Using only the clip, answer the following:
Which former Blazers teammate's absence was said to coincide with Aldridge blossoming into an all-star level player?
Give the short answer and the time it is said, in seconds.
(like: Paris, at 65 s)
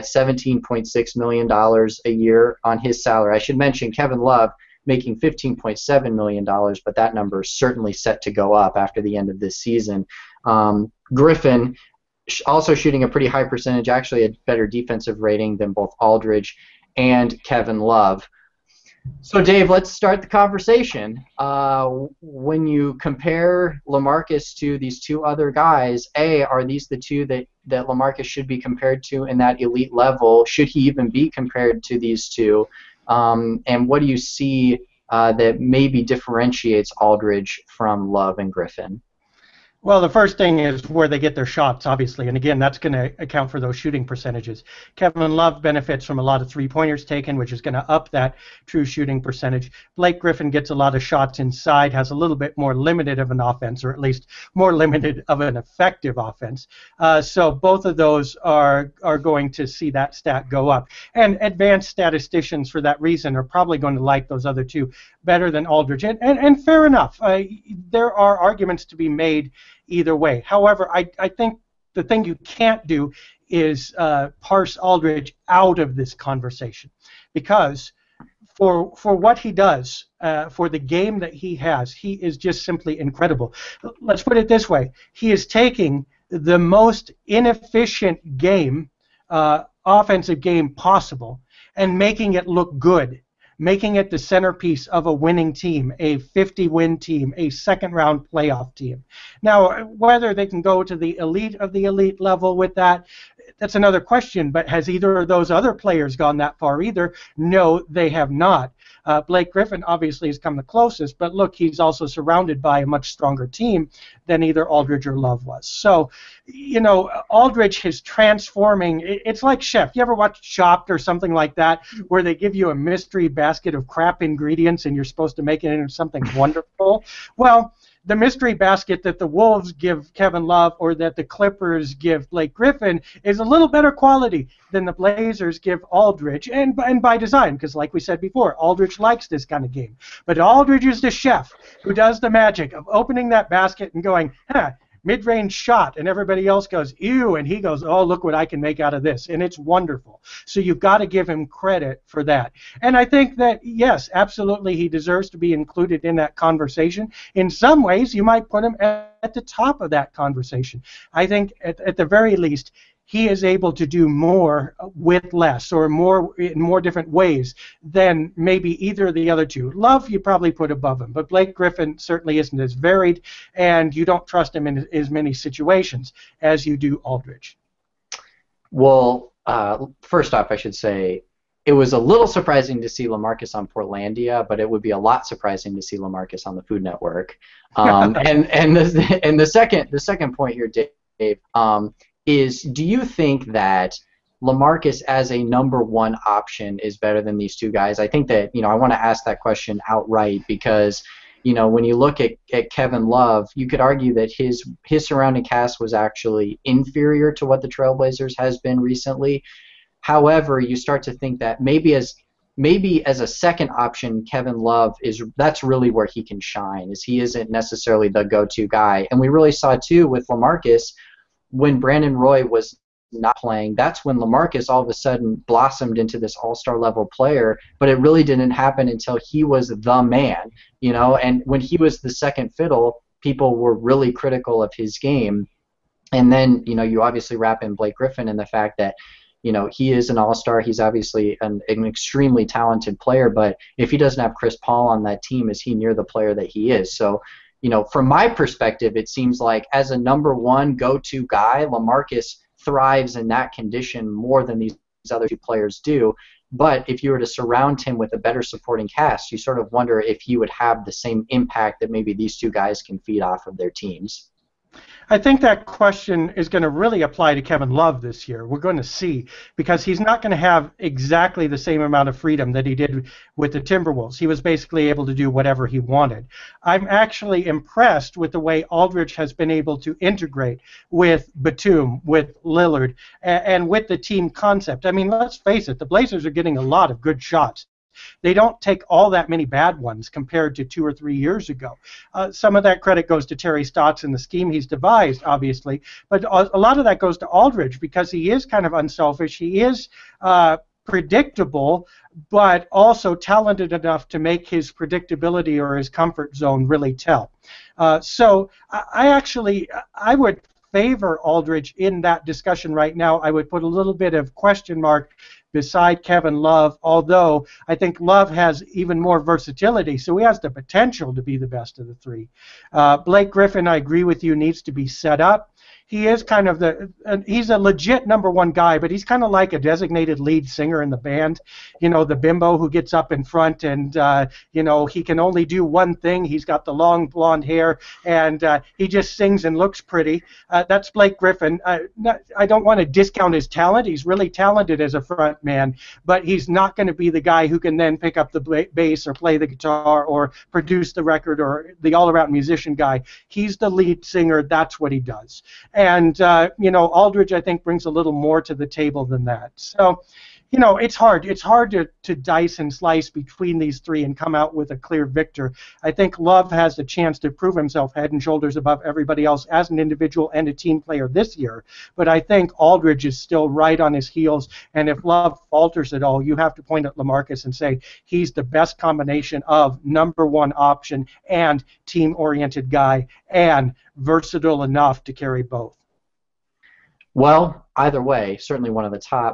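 Brandon Roy, at 221 s.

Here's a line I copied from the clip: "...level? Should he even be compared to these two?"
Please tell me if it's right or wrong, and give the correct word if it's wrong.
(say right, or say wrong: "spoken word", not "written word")
right.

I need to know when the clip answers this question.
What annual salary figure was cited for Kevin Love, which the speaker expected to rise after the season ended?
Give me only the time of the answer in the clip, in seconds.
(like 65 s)
5 s.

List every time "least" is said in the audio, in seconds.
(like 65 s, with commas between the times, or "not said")
53 s, 162 s.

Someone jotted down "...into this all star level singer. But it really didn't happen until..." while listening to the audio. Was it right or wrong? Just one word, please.
wrong.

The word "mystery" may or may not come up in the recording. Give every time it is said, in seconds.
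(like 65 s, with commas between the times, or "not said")
122 s, 128 s.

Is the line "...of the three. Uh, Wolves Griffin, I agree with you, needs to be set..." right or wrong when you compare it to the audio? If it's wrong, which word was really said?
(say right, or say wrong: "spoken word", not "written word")
wrong: "Blake", not "Wolves".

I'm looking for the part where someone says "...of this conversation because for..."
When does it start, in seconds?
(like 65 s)
75 s.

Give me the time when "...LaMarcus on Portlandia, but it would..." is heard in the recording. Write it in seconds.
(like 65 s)
183 s.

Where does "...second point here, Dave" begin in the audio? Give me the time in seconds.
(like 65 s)
189 s.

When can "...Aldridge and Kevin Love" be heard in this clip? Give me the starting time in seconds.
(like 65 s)
15 s.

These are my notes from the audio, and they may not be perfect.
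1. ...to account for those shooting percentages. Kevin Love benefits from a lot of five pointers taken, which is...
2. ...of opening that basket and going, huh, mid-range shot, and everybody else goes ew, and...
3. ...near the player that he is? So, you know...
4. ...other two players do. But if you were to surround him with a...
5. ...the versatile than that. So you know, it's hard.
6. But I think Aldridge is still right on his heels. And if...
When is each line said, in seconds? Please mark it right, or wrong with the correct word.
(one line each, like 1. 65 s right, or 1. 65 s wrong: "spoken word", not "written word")
1. 42 s wrong: "three", not "five"
2. 142 s right
3. 245 s right
4. 255 s right
5. 358 s wrong: "table", not "versatile"
6. 371 s right.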